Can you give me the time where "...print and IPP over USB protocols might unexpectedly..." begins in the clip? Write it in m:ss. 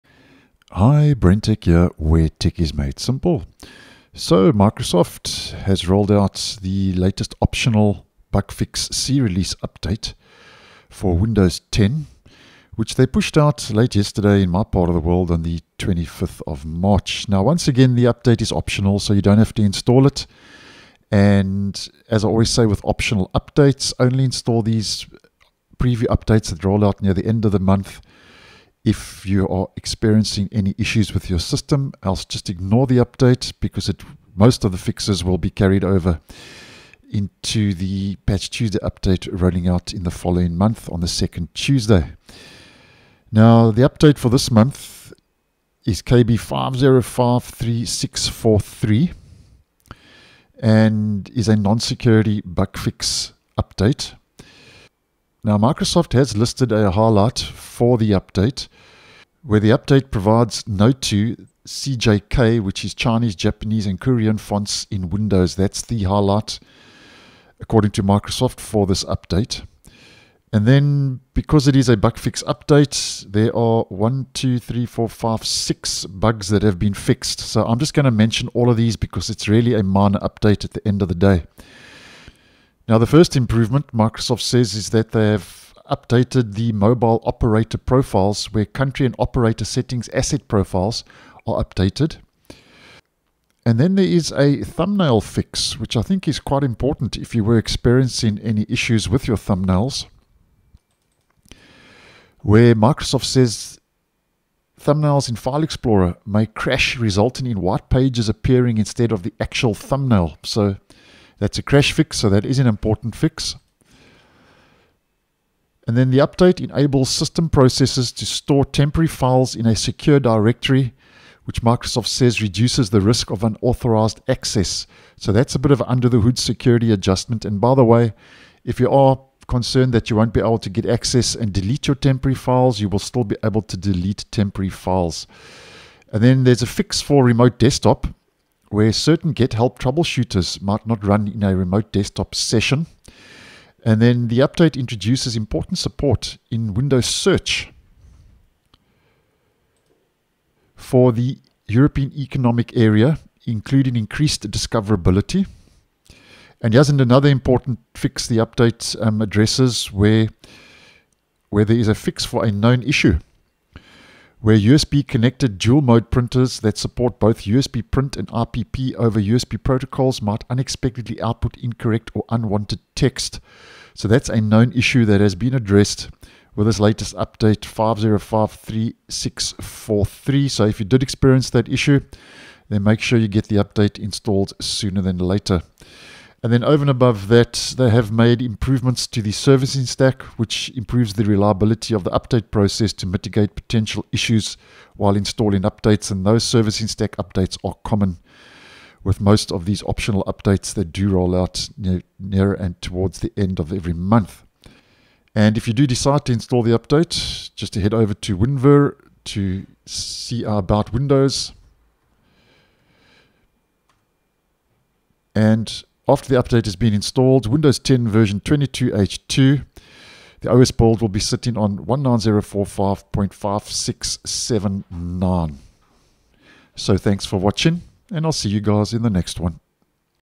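2:47.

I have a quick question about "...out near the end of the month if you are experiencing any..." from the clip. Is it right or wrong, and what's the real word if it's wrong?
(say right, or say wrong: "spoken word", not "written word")
right.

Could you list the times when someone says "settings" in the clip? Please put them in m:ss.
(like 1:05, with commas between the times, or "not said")
1:29.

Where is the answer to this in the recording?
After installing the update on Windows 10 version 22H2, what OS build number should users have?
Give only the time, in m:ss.
3:41.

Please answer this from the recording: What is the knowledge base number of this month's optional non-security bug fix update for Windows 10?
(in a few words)
KB5053643.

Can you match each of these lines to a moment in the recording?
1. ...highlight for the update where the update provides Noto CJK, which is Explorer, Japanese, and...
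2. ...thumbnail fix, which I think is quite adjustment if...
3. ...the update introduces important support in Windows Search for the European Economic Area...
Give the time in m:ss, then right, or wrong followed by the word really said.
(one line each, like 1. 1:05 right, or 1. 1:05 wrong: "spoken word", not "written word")
1. 0:56 wrong: "Chinese", not "Explorer"
2. 1:34 wrong: "important", not "adjustment"
3. 2:24 right.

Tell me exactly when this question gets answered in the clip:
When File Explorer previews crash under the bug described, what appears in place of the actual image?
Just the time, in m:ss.
1:47.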